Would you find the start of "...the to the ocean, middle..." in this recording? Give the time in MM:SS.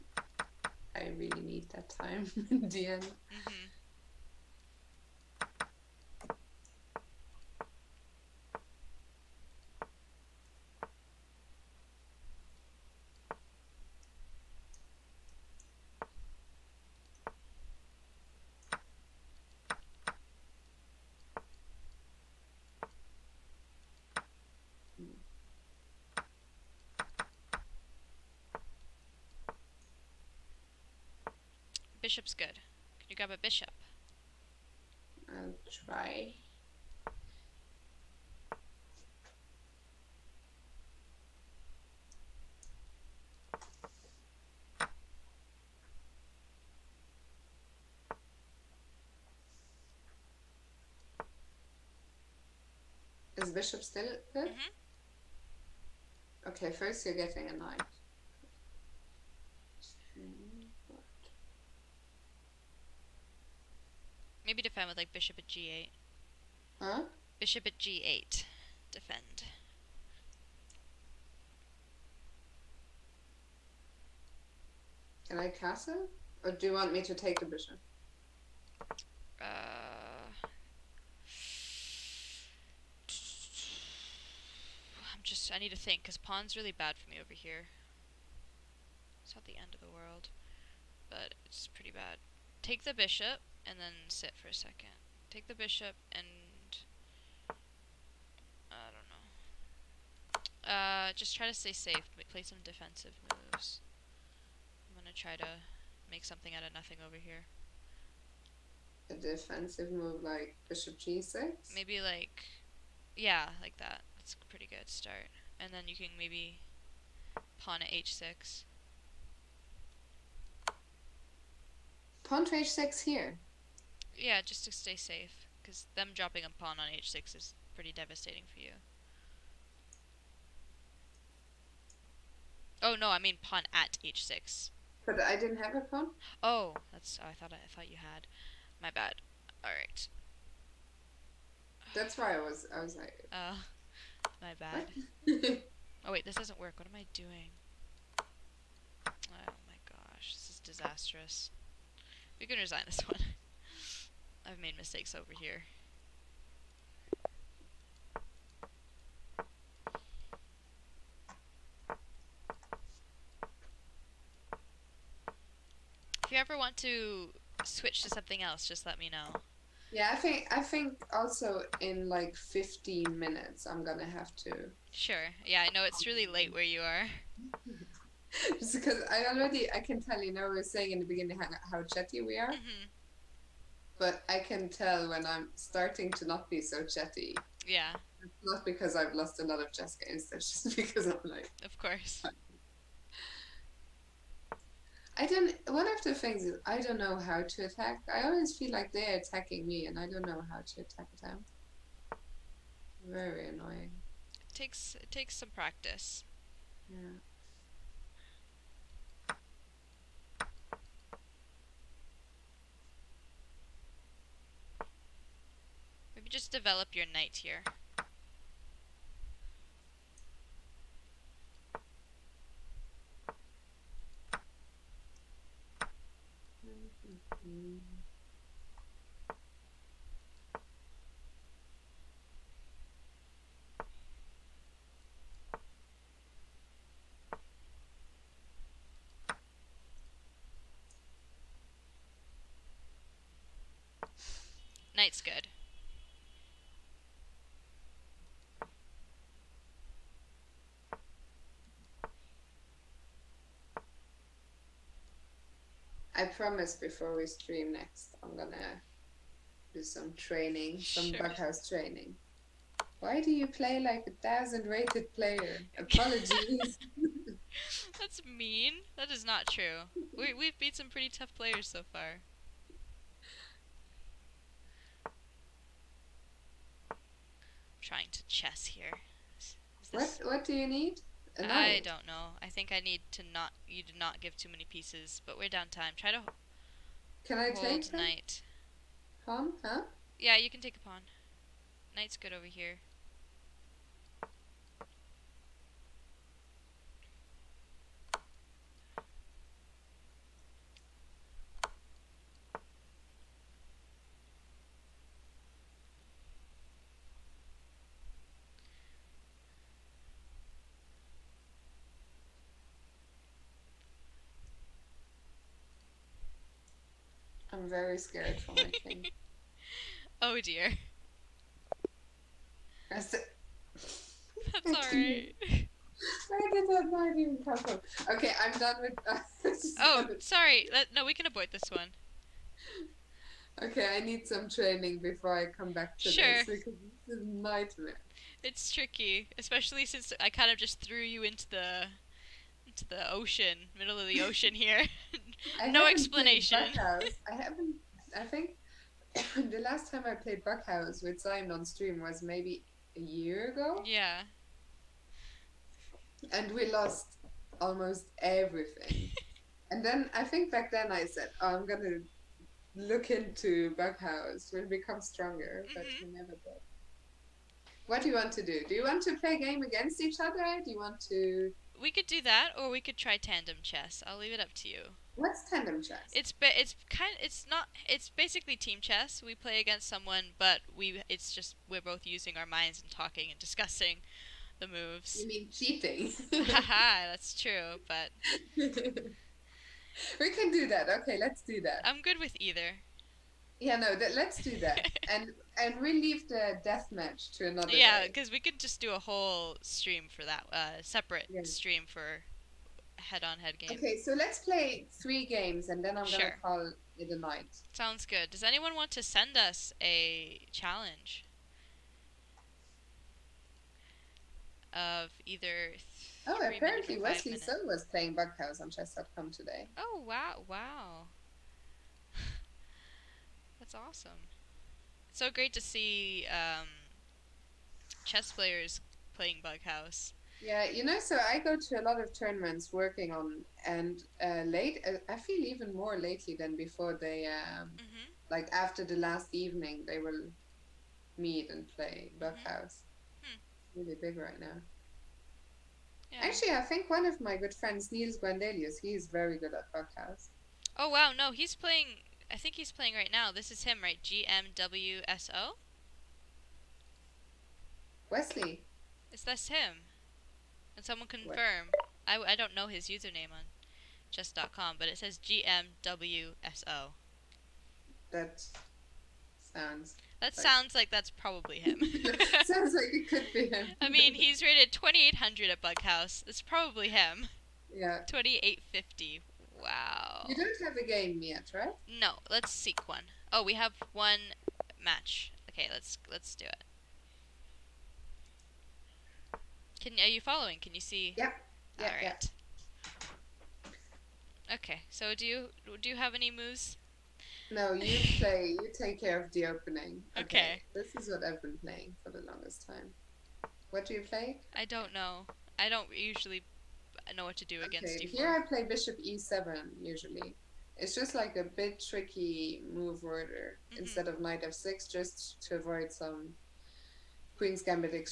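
05:41.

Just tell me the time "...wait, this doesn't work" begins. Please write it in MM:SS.
02:26.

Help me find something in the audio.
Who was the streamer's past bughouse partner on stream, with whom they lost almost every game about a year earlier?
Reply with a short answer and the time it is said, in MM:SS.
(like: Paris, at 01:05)
Simon, at 05:51.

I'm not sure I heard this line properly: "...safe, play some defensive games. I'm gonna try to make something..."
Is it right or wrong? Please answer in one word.
wrong.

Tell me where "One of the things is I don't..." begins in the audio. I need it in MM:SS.
03:15.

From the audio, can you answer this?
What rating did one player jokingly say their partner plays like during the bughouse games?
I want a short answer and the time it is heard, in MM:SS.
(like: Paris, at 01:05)
1000, at 04:24.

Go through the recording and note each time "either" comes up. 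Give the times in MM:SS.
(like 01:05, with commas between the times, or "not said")
06:32, 06:55.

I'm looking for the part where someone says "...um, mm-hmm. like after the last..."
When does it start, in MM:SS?
07:17.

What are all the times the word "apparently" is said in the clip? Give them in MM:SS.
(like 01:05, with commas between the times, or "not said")
06:56.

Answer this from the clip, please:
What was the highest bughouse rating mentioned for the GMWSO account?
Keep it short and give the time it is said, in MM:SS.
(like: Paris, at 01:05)
2850, at 07:58.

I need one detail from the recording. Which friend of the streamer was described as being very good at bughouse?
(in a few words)
Nils Grandelius.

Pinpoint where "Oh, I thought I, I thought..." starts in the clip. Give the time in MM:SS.
02:17.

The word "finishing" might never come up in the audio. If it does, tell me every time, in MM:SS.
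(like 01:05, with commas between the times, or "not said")
not said.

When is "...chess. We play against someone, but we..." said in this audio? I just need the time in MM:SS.
06:18.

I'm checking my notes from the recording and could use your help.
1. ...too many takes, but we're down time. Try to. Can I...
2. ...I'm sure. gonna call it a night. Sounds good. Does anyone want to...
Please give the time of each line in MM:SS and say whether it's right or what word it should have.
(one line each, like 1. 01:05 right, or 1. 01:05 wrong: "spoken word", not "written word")
1. 04:44 wrong: "pieces", not "takes"
2. 06:45 right.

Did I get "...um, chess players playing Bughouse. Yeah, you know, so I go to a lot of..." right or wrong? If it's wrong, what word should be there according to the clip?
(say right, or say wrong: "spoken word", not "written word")
right.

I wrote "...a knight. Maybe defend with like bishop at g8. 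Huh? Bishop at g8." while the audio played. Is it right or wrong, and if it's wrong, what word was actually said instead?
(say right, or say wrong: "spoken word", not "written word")
right.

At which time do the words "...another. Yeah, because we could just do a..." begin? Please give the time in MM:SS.
06:37.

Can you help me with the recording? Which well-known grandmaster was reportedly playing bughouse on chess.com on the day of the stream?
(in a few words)
Wesley So.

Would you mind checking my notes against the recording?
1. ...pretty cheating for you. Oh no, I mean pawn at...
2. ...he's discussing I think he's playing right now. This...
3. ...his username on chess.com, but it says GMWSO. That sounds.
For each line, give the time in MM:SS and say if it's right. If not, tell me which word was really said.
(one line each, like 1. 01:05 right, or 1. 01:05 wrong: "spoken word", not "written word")
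1. 02:07 wrong: "devastating", not "cheating"
2. 07:31 wrong: "playing", not "discussing"
3. 07:42 right.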